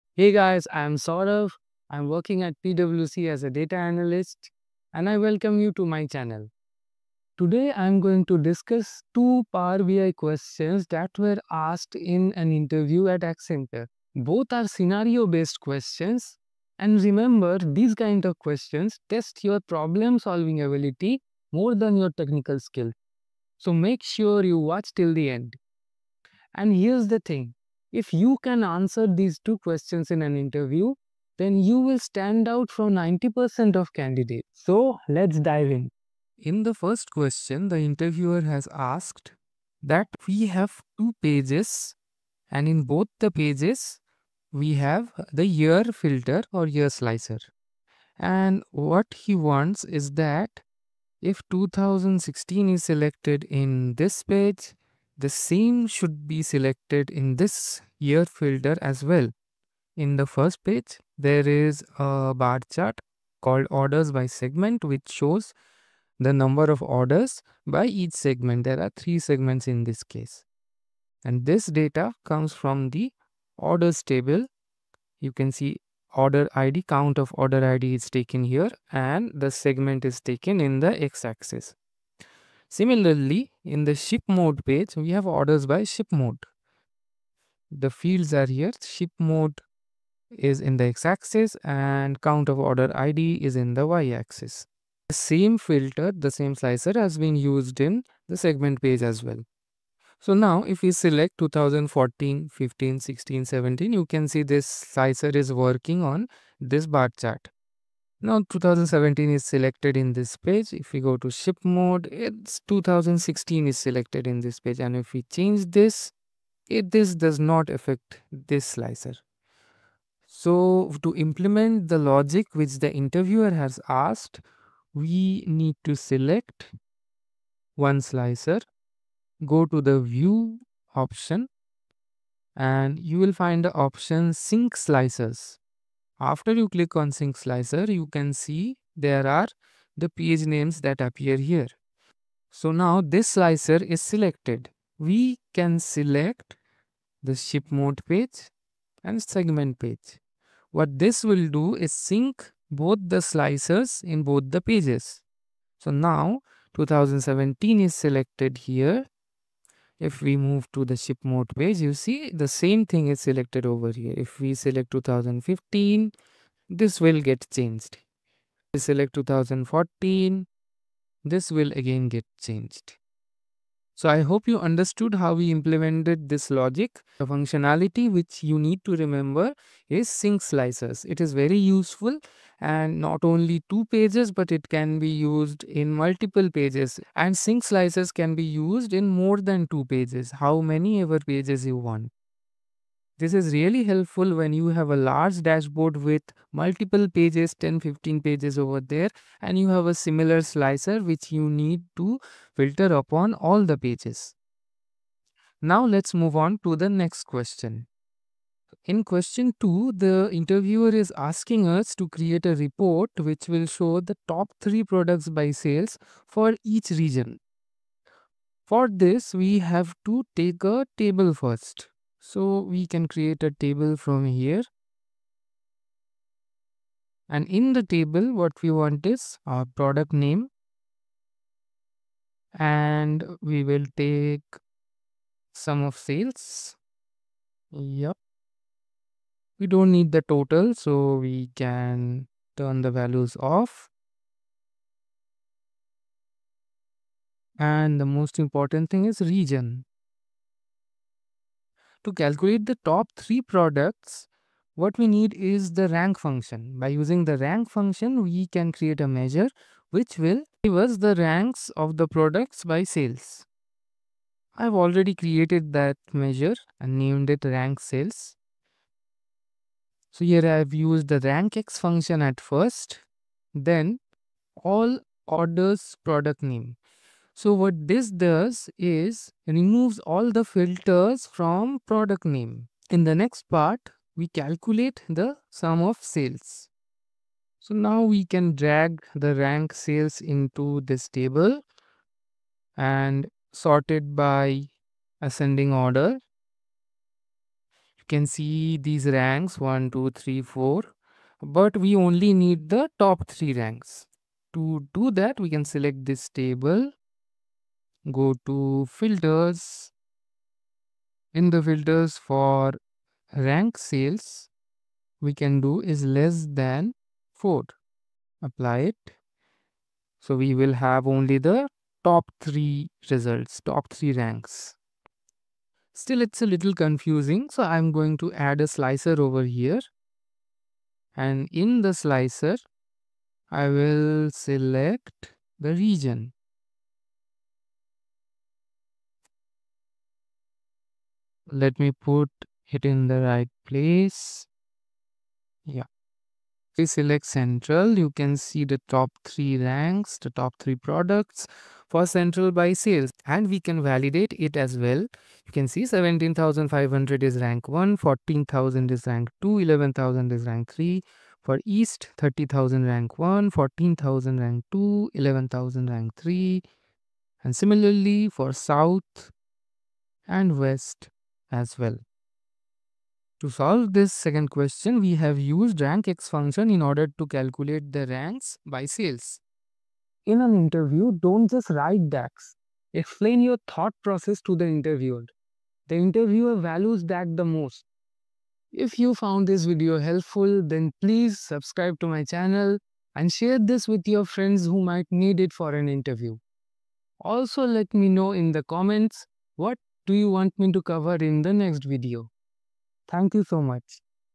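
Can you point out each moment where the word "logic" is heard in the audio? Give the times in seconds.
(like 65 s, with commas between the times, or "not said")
121 s, 176 s.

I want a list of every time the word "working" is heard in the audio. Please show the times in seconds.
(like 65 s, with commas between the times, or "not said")
2 s, 105 s.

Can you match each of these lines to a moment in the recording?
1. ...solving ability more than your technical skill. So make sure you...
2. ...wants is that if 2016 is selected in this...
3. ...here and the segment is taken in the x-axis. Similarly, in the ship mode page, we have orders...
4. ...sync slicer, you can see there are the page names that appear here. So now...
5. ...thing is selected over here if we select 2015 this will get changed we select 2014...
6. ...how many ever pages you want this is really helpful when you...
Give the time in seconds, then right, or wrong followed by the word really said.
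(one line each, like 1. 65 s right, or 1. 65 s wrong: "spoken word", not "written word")
1. 20 s right
2. 49 s right
3. 78 s right
4. 137 s right
5. 162 s right
6. 190 s right.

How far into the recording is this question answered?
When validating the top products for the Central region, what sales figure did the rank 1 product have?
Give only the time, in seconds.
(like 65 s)
355 s.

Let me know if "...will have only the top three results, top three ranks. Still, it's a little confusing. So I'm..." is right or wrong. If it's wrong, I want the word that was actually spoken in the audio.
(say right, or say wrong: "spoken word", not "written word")
right.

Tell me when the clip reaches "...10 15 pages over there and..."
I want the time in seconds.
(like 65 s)
197 s.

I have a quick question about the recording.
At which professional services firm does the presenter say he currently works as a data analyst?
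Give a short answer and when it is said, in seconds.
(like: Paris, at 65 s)
PwC, at 2 s.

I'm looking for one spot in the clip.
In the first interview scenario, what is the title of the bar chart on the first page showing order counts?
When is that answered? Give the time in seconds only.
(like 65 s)
63 s.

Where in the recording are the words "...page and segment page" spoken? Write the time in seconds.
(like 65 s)
148 s.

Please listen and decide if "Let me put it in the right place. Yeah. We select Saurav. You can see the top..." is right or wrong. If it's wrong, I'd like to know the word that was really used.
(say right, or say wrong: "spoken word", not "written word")
wrong: "Central", not "Saurav".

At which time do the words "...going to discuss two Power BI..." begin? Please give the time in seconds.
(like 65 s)
8 s.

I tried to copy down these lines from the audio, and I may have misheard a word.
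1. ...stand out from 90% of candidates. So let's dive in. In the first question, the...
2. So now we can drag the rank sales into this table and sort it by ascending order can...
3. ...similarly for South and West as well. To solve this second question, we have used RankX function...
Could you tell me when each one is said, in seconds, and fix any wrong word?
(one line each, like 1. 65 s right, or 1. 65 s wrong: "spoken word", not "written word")
1. 31 s right
2. 287 s right
3. 367 s right.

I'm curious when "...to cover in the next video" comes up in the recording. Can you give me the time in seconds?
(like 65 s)
400 s.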